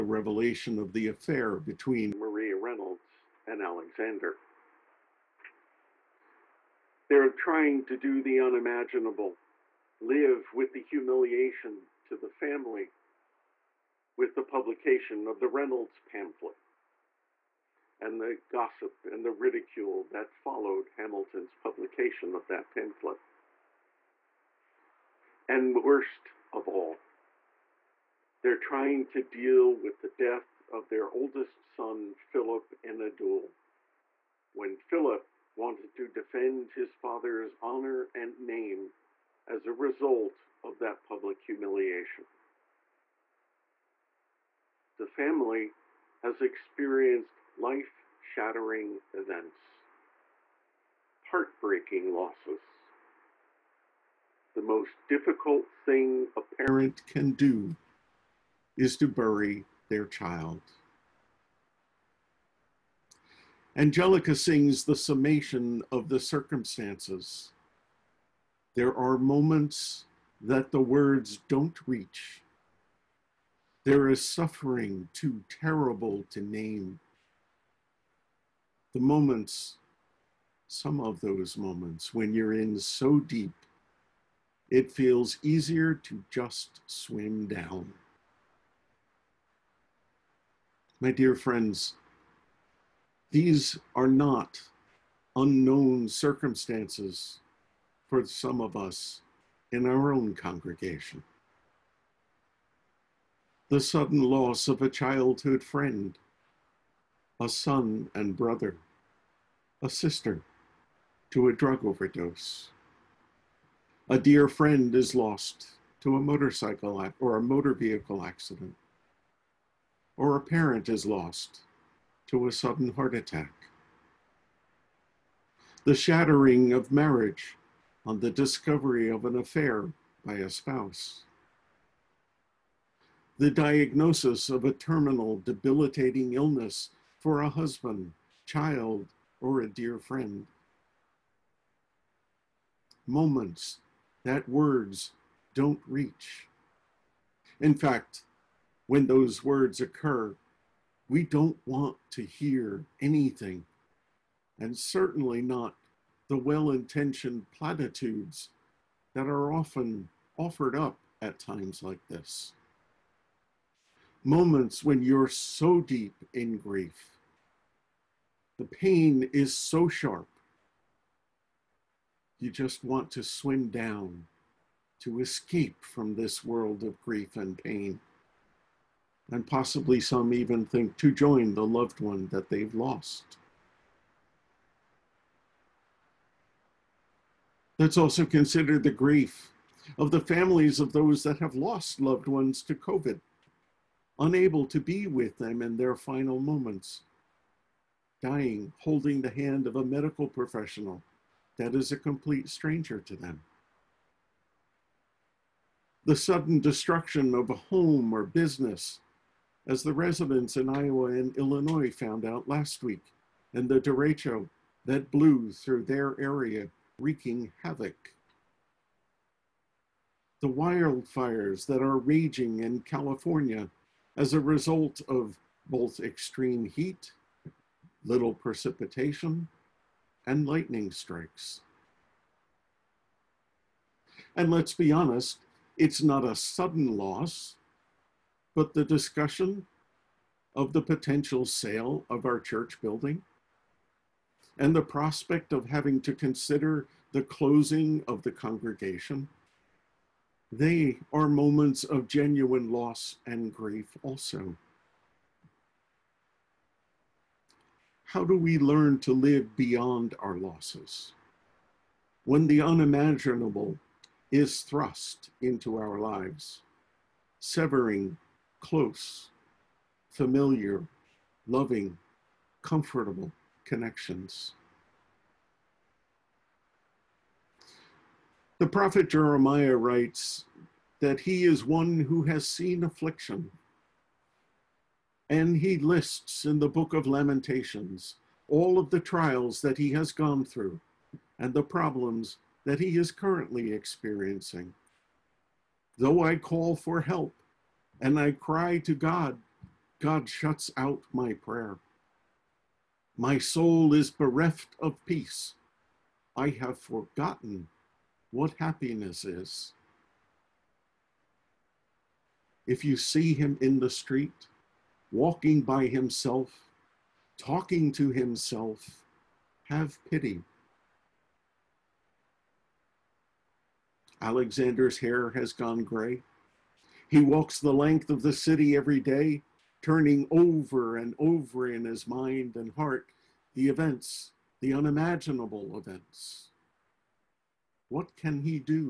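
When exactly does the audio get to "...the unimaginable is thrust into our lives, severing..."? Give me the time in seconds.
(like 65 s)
262 s.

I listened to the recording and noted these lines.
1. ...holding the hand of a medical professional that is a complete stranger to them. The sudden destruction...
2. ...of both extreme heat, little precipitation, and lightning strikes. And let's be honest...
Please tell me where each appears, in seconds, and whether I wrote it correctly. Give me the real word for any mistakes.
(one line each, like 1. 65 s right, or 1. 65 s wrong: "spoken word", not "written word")
1. 198 s right
2. 225 s right.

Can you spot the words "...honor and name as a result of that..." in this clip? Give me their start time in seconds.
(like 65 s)
37 s.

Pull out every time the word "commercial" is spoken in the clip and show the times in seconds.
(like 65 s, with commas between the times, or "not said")
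not said.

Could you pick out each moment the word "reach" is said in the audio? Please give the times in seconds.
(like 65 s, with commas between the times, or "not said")
71 s, 145 s.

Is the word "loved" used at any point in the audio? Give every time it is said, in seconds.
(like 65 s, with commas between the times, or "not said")
181 s, 192 s.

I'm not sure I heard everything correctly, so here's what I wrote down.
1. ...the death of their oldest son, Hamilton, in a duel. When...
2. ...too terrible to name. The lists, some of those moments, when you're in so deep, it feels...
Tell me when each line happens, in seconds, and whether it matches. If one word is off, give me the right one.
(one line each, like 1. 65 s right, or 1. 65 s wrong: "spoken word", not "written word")
1. 30 s wrong: "Philip", not "Hamilton"
2. 75 s wrong: "moments", not "lists".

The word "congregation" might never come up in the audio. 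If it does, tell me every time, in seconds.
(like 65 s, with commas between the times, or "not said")
100 s, 248 s.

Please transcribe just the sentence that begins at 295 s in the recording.
Though I call for help and I cry to God, God shuts out my prayer.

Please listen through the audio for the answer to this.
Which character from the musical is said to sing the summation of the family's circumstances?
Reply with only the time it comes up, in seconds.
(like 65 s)
63 s.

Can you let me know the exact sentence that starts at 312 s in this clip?
If you see him in the street, walking by himself, talking to himself, have pity.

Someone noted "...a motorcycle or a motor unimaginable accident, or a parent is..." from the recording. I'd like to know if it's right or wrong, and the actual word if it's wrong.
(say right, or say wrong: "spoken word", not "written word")
wrong: "vehicle", not "unimaginable".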